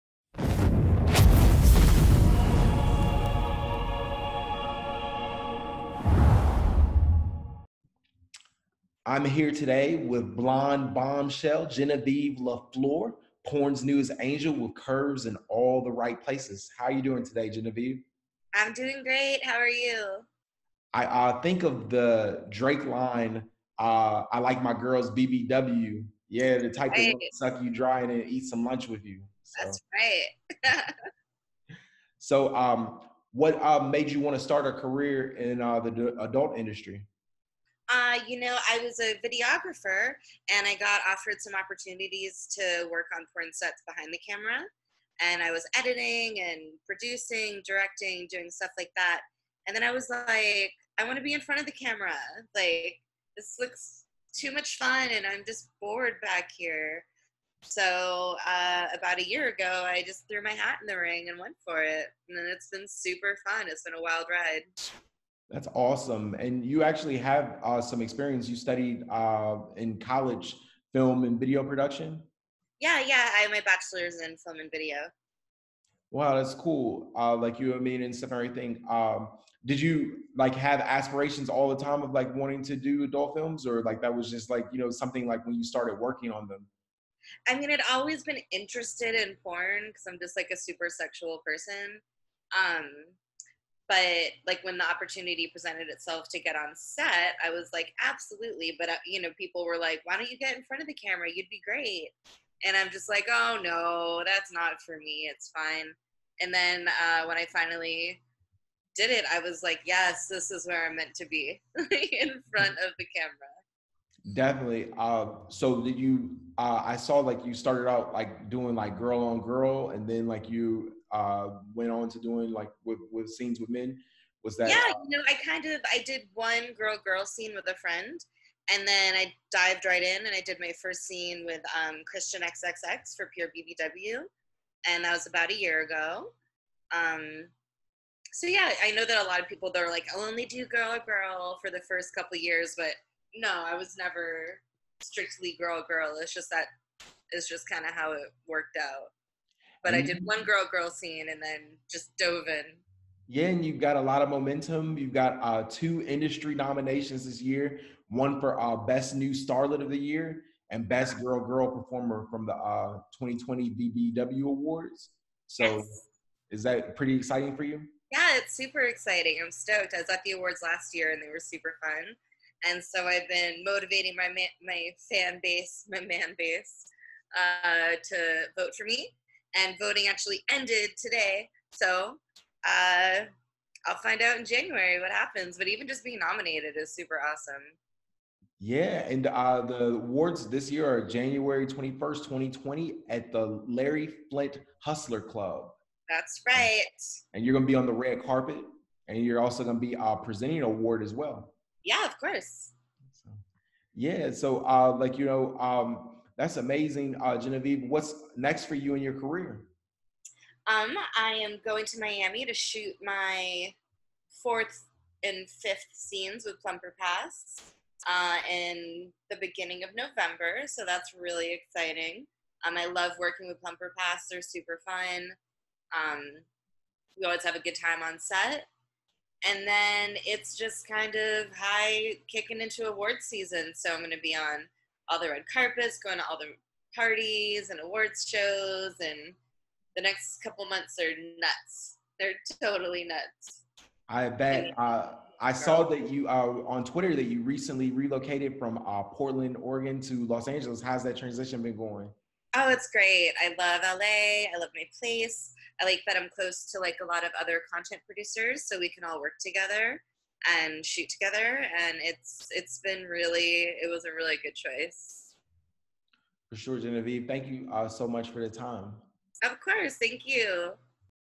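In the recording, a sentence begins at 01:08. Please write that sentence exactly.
You studied uh, in college film and video production?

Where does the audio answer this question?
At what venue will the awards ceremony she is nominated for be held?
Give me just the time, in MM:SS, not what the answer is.
03:13.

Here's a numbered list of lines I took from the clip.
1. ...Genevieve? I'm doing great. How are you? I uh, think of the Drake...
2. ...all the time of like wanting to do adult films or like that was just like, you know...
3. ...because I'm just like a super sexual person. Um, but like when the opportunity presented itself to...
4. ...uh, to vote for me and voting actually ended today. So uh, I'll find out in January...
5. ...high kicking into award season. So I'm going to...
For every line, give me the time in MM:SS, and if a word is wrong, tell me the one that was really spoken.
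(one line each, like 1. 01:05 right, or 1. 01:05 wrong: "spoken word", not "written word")
1. 00:17 right
2. 01:21 right
3. 01:29 right
4. 02:57 right
5. 03:51 right.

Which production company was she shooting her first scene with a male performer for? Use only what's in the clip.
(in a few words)
Pure BBW.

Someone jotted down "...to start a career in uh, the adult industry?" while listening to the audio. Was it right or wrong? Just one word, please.
right.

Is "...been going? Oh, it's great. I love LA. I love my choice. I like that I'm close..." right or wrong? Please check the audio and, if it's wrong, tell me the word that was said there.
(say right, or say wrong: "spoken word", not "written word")
wrong: "place", not "choice".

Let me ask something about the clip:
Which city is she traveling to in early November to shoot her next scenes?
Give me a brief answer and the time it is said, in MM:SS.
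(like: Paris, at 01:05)
Miami, at 03:31.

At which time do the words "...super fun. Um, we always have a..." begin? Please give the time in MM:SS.
03:44.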